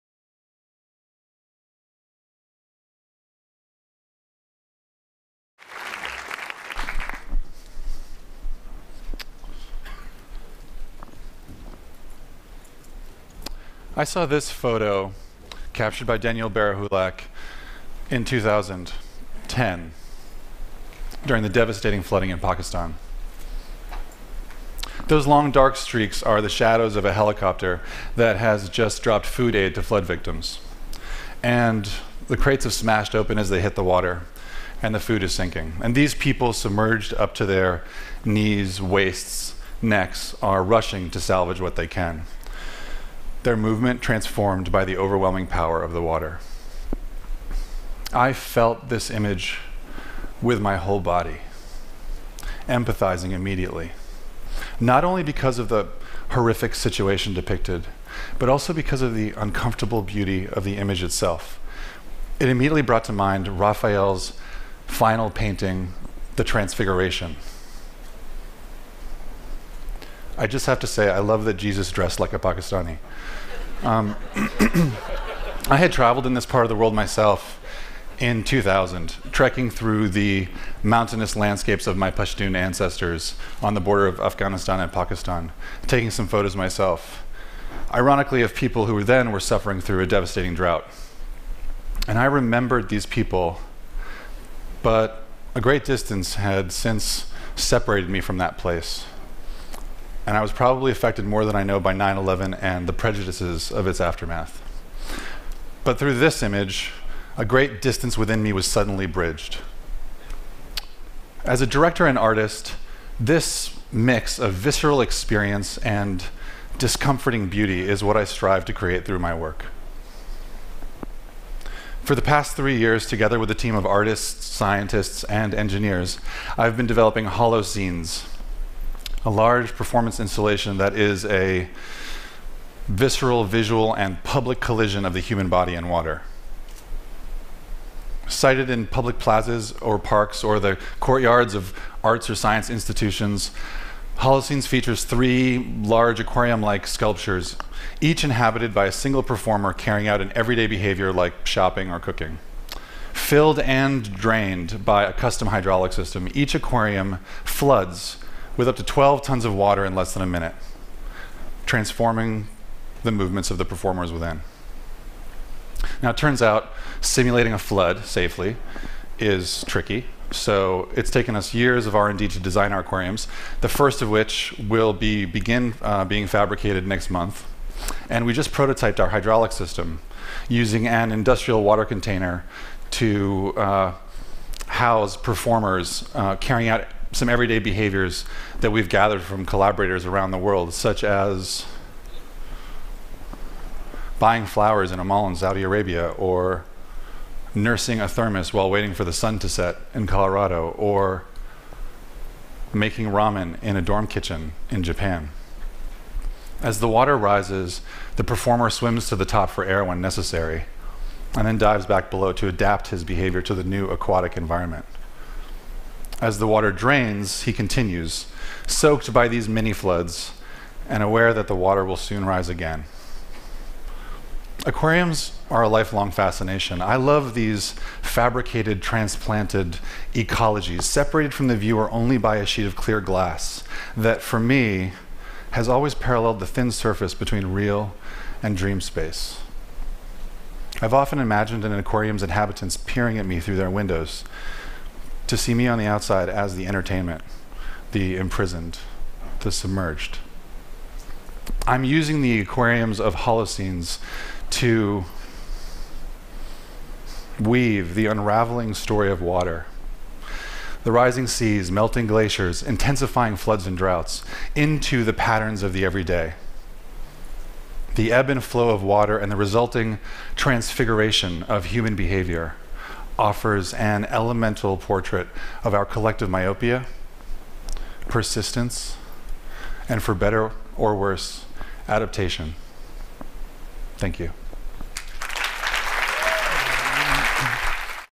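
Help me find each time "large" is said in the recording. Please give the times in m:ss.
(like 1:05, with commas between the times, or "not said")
2:09, 2:25.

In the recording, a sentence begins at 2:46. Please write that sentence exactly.
Now, it turns out simulating a flood safely is tricky.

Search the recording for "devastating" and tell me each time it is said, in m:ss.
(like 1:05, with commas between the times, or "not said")
0:21, 1:30.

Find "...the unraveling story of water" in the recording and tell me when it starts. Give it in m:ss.
4:17.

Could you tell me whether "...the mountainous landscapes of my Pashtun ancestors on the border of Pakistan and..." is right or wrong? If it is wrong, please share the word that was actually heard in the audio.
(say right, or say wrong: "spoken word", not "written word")
wrong: "Afghanistan", not "Pakistan".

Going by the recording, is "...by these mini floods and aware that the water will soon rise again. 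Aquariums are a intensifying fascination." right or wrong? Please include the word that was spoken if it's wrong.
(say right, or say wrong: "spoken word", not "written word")
wrong: "lifelong", not "intensifying".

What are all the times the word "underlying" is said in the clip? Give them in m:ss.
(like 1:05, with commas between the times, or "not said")
not said.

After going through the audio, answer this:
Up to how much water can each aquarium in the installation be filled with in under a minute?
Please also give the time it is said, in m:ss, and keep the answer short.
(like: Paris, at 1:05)
12 tons, at 2:38.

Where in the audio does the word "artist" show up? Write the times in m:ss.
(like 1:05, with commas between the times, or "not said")
1:52, 2:03.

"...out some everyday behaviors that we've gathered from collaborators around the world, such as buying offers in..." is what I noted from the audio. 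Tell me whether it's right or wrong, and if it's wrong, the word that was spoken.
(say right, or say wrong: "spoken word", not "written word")
wrong: "flowers", not "offers".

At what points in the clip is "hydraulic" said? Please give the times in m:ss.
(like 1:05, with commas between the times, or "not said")
2:35, 2:59.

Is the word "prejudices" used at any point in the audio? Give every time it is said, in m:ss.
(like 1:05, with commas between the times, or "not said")
1:42.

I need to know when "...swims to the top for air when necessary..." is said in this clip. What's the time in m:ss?
3:28.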